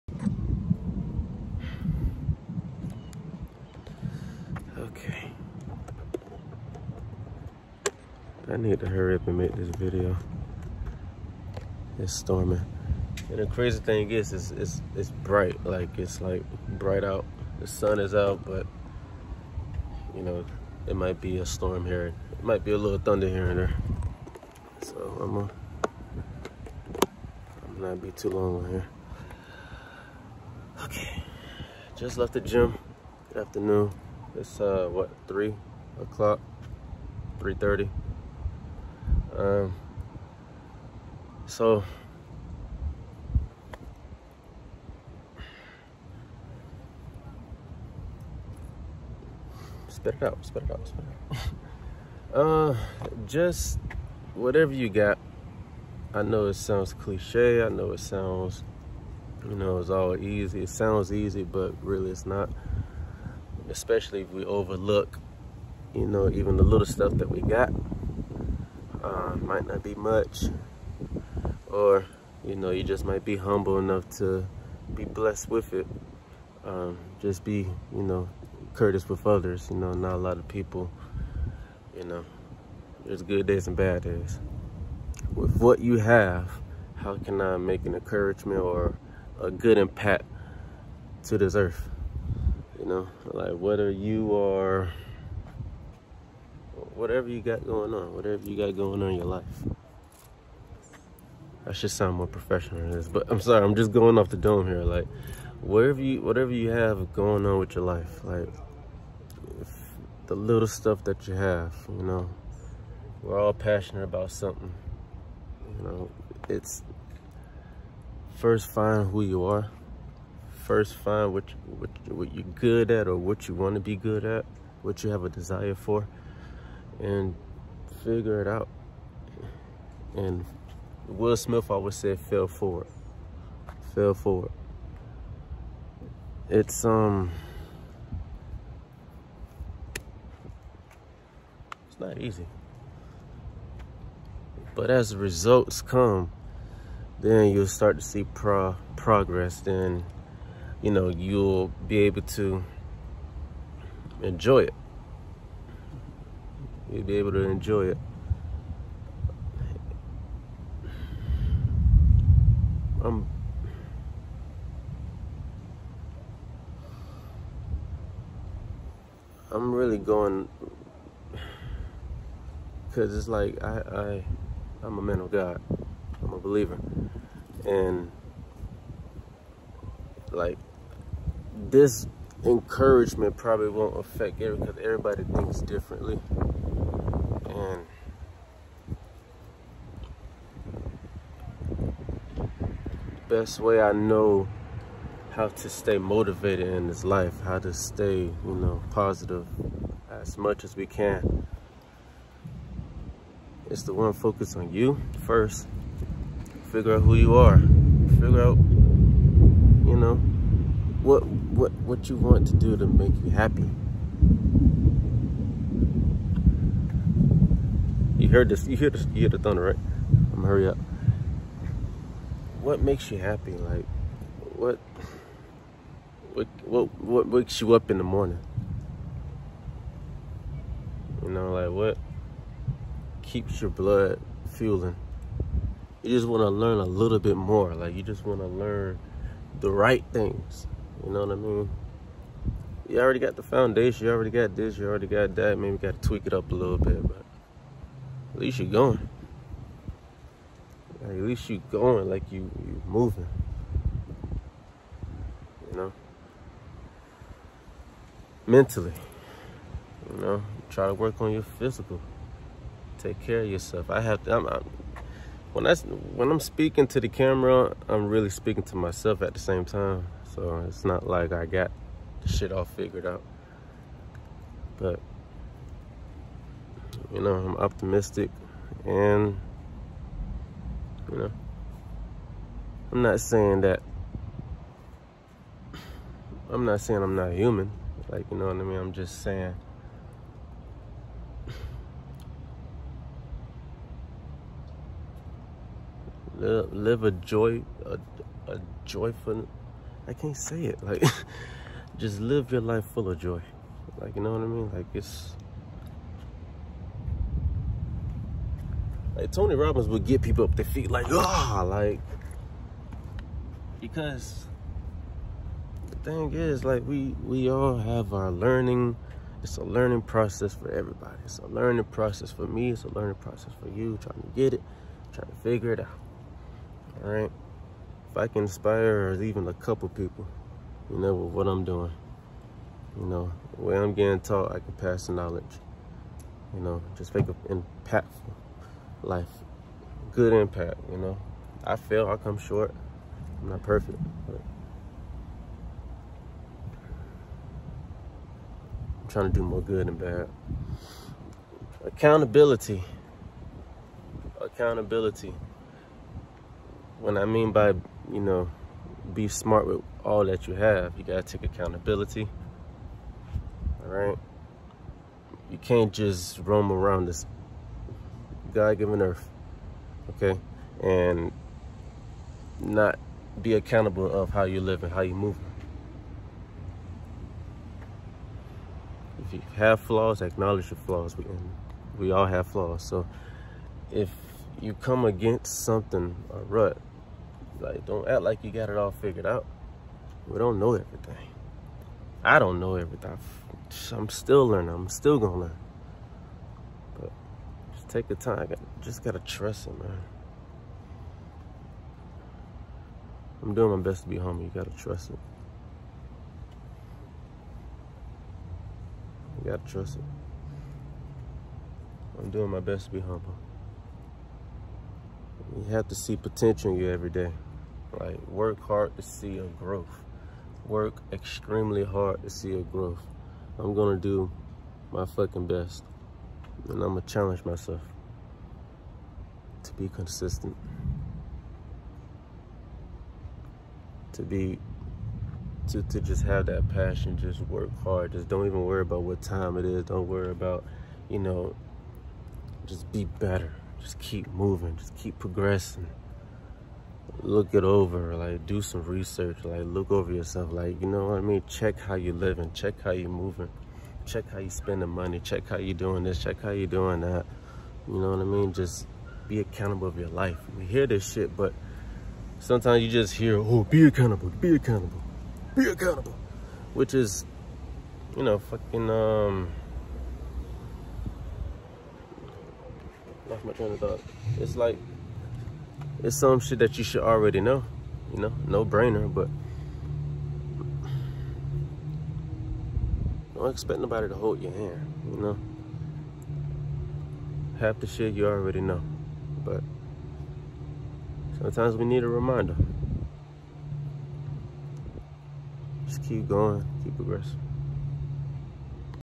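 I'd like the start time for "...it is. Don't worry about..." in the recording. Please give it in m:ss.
7:19.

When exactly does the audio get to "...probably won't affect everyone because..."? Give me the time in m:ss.
3:03.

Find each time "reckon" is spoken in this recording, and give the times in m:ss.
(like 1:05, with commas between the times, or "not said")
not said.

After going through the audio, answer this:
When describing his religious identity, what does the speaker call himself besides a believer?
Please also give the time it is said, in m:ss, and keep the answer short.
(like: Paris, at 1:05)
A man of God, at 2:54.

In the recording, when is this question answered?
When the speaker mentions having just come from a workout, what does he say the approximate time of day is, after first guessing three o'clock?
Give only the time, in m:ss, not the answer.
0:37.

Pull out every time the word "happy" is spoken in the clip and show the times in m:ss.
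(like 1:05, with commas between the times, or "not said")
3:33, 3:43.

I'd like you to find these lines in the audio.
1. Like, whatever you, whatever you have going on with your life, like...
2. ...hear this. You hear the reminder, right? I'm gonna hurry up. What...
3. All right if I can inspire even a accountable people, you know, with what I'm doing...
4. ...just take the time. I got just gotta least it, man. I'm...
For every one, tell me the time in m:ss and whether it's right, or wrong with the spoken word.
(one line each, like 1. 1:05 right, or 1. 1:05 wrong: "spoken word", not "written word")
1. 1:44 right
2. 3:38 wrong: "thunder", not "reminder"
3. 5:27 wrong: "couple", not "accountable"
4. 6:37 wrong: "trust", not "least".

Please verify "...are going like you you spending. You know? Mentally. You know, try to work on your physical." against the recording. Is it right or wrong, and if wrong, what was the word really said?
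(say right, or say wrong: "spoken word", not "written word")
wrong: "moving", not "spending".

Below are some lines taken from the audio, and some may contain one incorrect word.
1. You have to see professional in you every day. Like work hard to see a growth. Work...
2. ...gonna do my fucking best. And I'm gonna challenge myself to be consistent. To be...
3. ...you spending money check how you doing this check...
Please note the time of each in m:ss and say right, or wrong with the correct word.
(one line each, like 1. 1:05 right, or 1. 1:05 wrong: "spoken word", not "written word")
1. 6:55 wrong: "potential", not "professional"
2. 7:03 right
3. 7:34 right.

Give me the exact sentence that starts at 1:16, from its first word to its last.
Um, just be, you know, courteous with others.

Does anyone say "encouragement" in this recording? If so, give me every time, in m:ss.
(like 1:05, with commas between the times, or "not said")
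1:27, 3:02.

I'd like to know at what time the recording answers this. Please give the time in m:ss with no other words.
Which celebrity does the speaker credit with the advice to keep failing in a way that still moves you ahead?
2:11.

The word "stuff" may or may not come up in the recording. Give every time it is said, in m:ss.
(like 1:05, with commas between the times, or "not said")
1:06, 1:50.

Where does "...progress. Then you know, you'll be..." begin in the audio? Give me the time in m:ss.
2:28.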